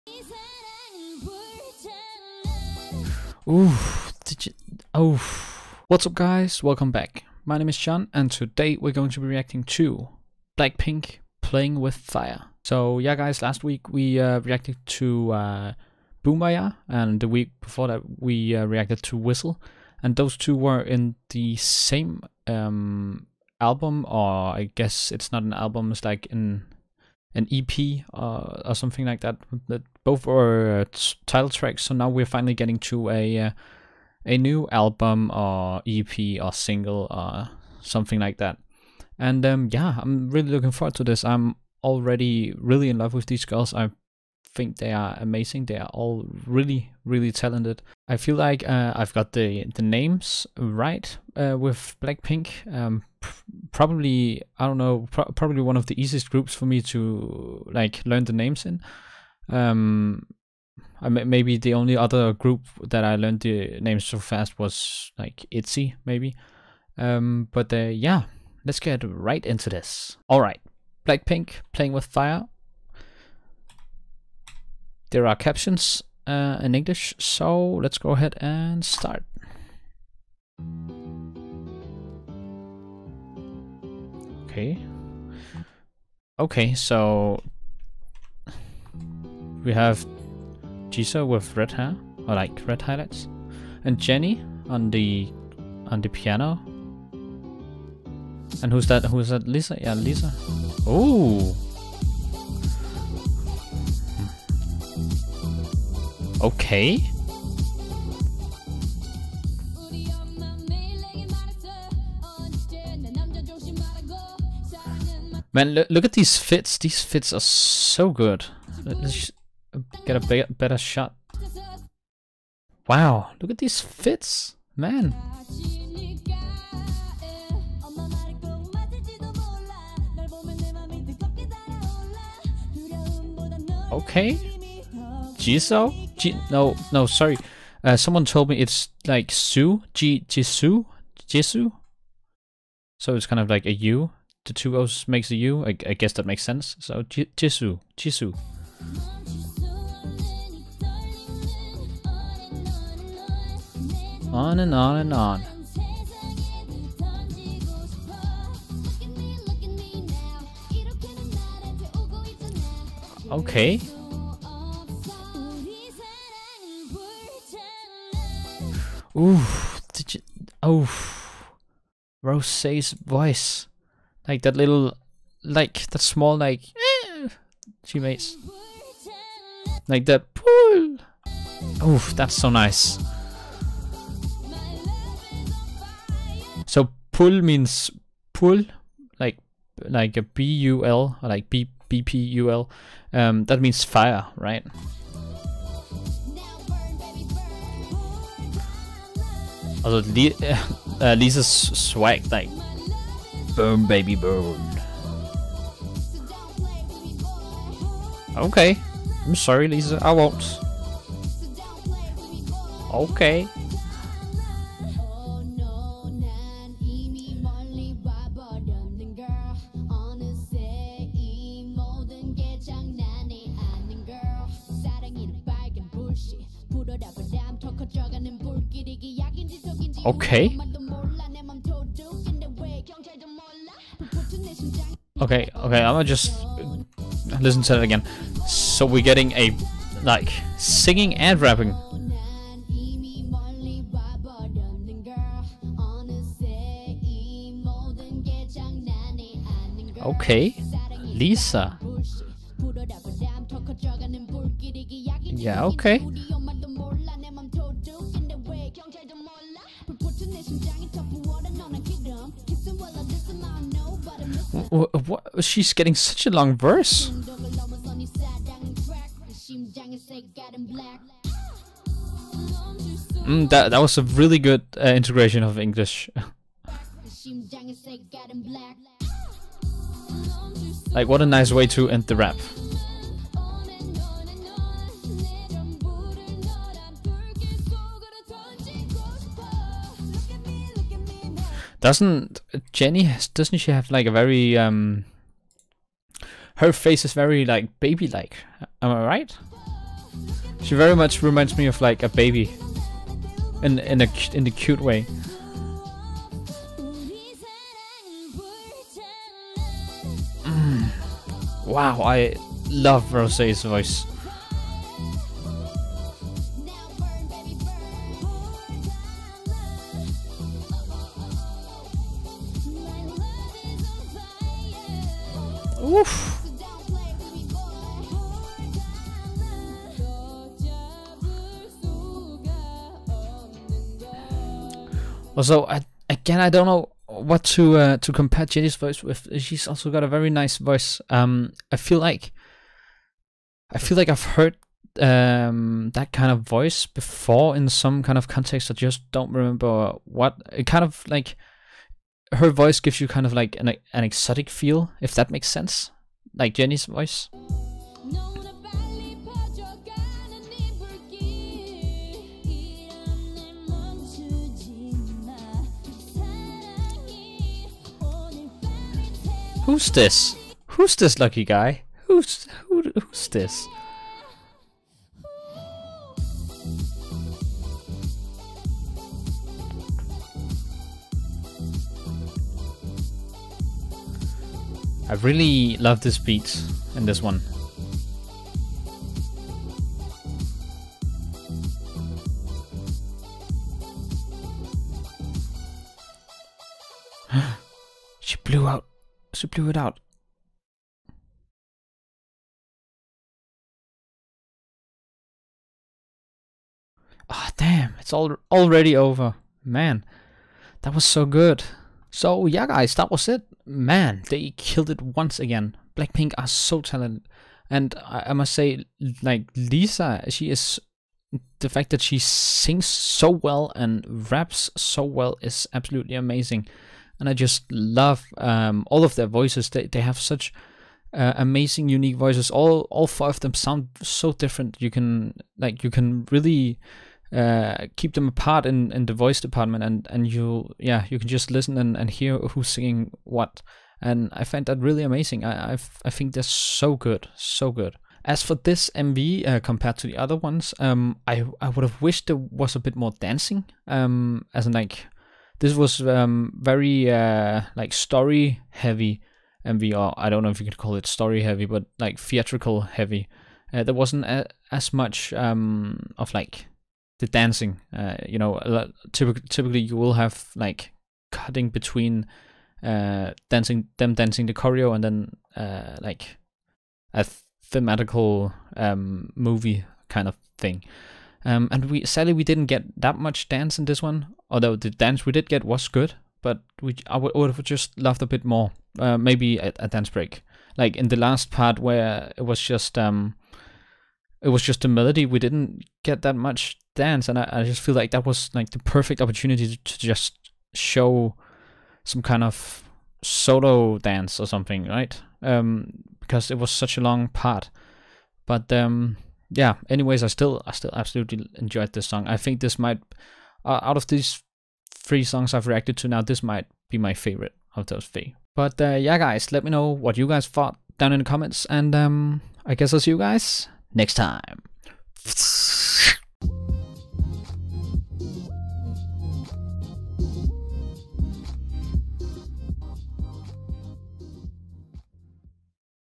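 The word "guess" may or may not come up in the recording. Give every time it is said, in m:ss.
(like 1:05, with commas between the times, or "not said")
0:24, 2:25, 8:42.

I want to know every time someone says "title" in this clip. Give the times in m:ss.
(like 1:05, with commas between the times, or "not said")
0:31.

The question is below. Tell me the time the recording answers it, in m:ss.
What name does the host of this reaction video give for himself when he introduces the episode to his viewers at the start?
0:07.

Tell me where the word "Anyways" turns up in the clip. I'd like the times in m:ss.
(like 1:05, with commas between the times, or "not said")
8:29.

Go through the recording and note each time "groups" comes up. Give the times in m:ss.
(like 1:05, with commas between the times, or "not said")
0:56, 1:02.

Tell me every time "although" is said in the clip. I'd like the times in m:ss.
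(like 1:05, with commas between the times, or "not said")
8:04.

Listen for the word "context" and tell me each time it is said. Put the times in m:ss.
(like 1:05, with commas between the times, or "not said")
5:48.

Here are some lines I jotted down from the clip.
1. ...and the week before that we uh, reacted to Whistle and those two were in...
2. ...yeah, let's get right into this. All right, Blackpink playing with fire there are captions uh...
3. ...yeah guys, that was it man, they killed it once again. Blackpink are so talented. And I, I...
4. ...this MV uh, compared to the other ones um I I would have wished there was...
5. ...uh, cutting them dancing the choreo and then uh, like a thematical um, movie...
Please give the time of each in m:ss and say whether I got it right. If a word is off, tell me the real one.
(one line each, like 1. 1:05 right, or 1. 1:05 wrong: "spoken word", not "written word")
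1. 0:16 right
2. 1:07 right
3. 6:52 right
4. 7:28 right
5. 7:52 wrong: "dancing", not "cutting".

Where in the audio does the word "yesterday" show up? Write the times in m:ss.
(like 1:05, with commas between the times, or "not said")
not said.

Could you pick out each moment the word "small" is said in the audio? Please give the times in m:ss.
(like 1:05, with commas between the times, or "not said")
2:56.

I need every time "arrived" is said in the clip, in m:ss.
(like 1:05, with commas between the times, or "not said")
not said.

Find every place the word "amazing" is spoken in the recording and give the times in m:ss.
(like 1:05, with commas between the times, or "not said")
0:45, 7:06, 7:11, 7:25.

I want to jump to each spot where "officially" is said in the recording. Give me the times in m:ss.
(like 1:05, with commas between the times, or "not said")
not said.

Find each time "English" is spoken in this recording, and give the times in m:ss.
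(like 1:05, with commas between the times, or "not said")
1:16, 4:35.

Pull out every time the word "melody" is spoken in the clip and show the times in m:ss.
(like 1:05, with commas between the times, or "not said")
8:14.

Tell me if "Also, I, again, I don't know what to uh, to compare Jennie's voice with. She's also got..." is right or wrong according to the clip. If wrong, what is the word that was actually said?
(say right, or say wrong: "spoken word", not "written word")
right.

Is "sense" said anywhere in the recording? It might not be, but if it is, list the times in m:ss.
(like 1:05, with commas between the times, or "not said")
2:26, 5:55.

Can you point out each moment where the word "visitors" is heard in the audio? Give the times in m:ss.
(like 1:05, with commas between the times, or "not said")
not said.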